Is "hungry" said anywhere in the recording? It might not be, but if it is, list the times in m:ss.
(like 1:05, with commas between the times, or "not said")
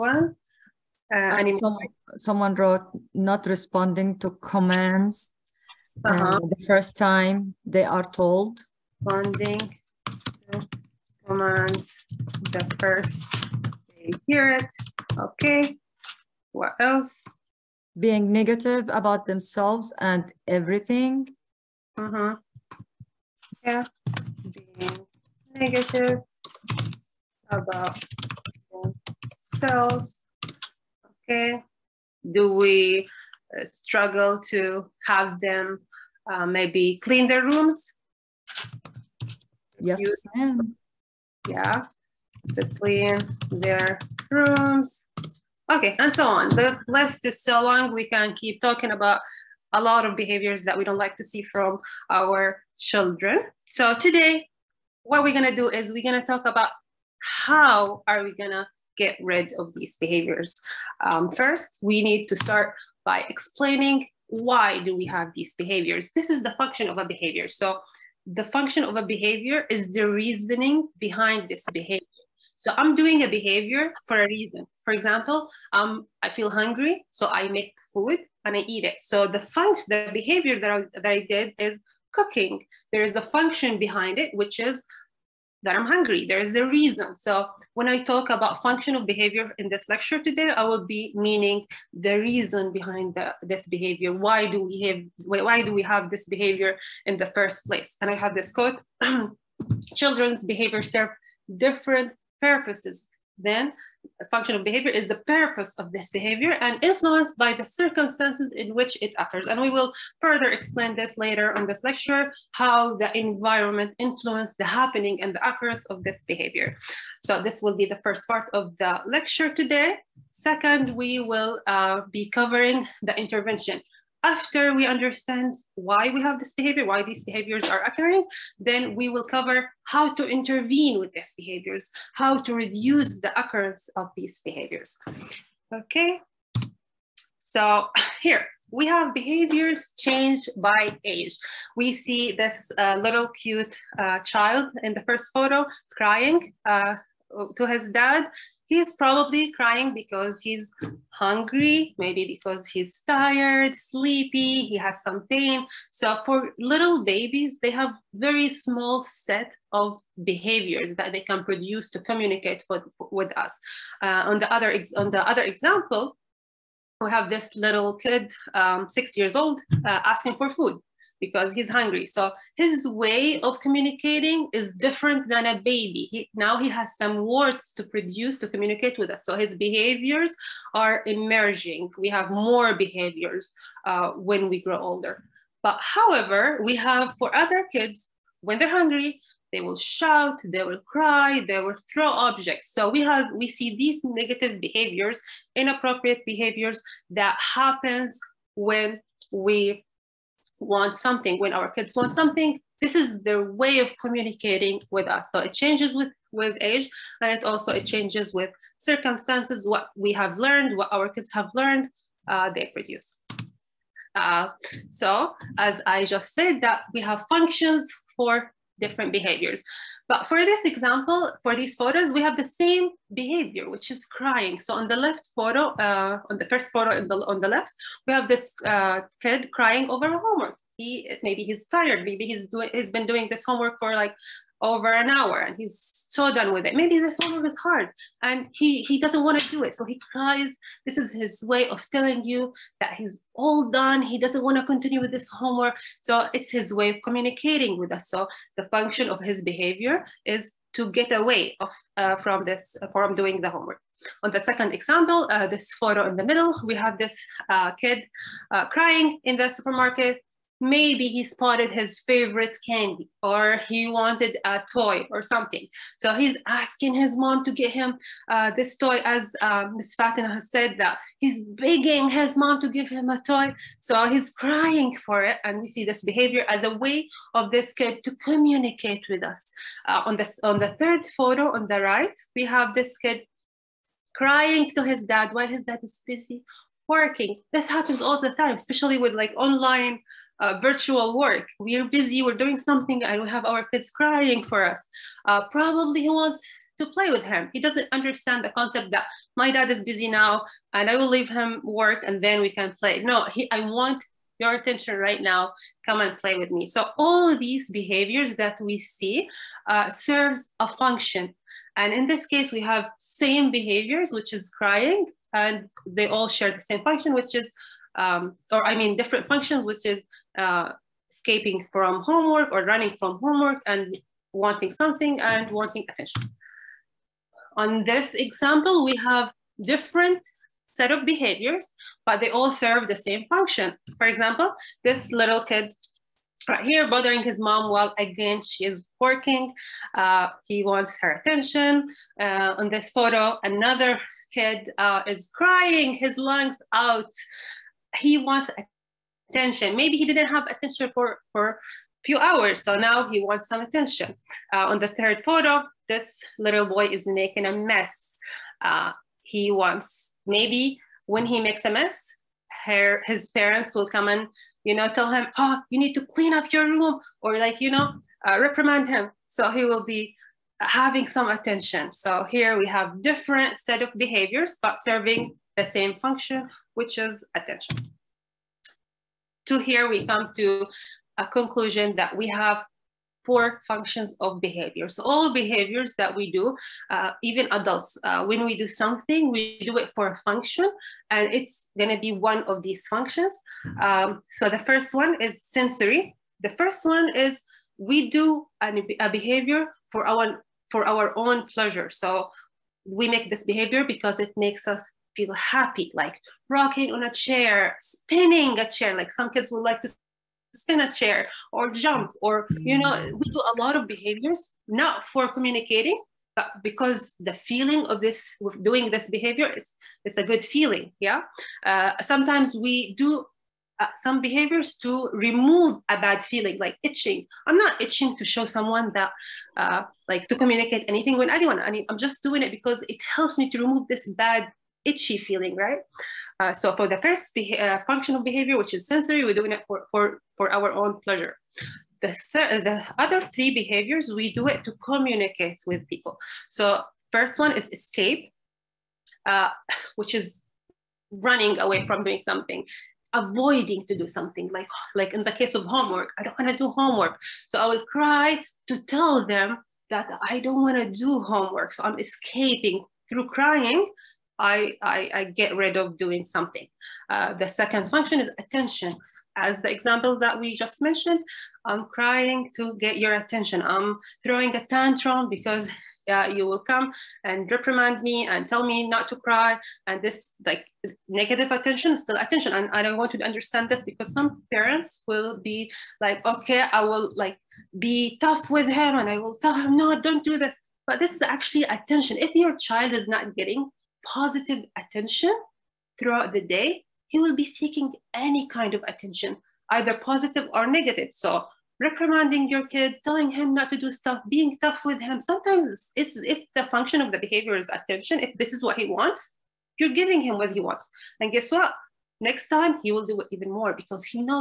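1:16, 1:25, 2:31, 2:51, 3:08.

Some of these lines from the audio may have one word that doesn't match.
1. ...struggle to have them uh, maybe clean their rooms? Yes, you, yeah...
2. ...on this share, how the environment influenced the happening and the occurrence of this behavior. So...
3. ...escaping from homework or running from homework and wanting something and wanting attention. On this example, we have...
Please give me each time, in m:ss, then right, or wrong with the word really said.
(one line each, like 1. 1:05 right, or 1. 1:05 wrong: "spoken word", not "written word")
1. 0:33 right
2. 1:51 wrong: "lecture", not "share"
3. 5:21 right.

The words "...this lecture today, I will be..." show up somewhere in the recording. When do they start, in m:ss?
1:29.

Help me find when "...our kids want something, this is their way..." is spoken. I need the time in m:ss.
3:21.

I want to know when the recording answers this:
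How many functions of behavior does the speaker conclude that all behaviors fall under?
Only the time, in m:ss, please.
6:23.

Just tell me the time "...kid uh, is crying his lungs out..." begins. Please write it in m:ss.
5:44.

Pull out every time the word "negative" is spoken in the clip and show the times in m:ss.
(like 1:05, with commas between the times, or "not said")
0:18, 0:25, 3:14, 8:01, 8:20.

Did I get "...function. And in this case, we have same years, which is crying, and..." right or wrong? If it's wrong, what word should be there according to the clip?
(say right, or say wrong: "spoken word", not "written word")
wrong: "behaviors", not "years".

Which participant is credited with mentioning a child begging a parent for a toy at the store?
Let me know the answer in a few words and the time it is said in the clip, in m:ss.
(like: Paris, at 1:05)
Ms. Fatima, at 4:29.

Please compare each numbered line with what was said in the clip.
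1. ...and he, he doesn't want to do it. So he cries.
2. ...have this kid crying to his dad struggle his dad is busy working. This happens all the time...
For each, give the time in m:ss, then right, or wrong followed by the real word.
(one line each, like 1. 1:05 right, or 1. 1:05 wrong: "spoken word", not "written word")
1. 3:58 right
2. 4:42 wrong: "while", not "struggle".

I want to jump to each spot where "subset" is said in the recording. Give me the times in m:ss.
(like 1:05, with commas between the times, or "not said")
not said.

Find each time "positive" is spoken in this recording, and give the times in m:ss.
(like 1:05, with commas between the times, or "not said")
8:14, 8:19.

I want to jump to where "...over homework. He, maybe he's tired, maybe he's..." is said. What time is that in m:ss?
3:49.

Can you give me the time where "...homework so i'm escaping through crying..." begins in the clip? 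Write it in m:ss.
7:41.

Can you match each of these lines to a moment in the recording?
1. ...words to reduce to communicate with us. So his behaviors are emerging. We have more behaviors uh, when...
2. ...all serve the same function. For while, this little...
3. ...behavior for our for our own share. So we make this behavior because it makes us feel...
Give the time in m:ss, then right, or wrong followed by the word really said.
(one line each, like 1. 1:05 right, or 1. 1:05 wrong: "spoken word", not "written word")
1. 2:57 wrong: "produce", not "reduce"
2. 5:32 wrong: "example", not "while"
3. 6:39 wrong: "pleasure", not "share".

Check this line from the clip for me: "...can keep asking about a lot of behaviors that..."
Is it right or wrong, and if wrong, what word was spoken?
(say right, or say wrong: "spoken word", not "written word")
wrong: "talking", not "asking".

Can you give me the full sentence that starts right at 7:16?
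Uh, so for the first uh, functional behavior, which is sensory, we're doing it for, for, for our own pleasure.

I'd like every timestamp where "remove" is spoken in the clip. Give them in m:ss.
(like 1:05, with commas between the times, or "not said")
7:05, 7:13.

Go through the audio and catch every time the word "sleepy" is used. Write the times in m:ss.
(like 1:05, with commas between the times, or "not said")
2:33.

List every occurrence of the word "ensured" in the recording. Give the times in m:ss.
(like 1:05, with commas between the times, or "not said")
not said.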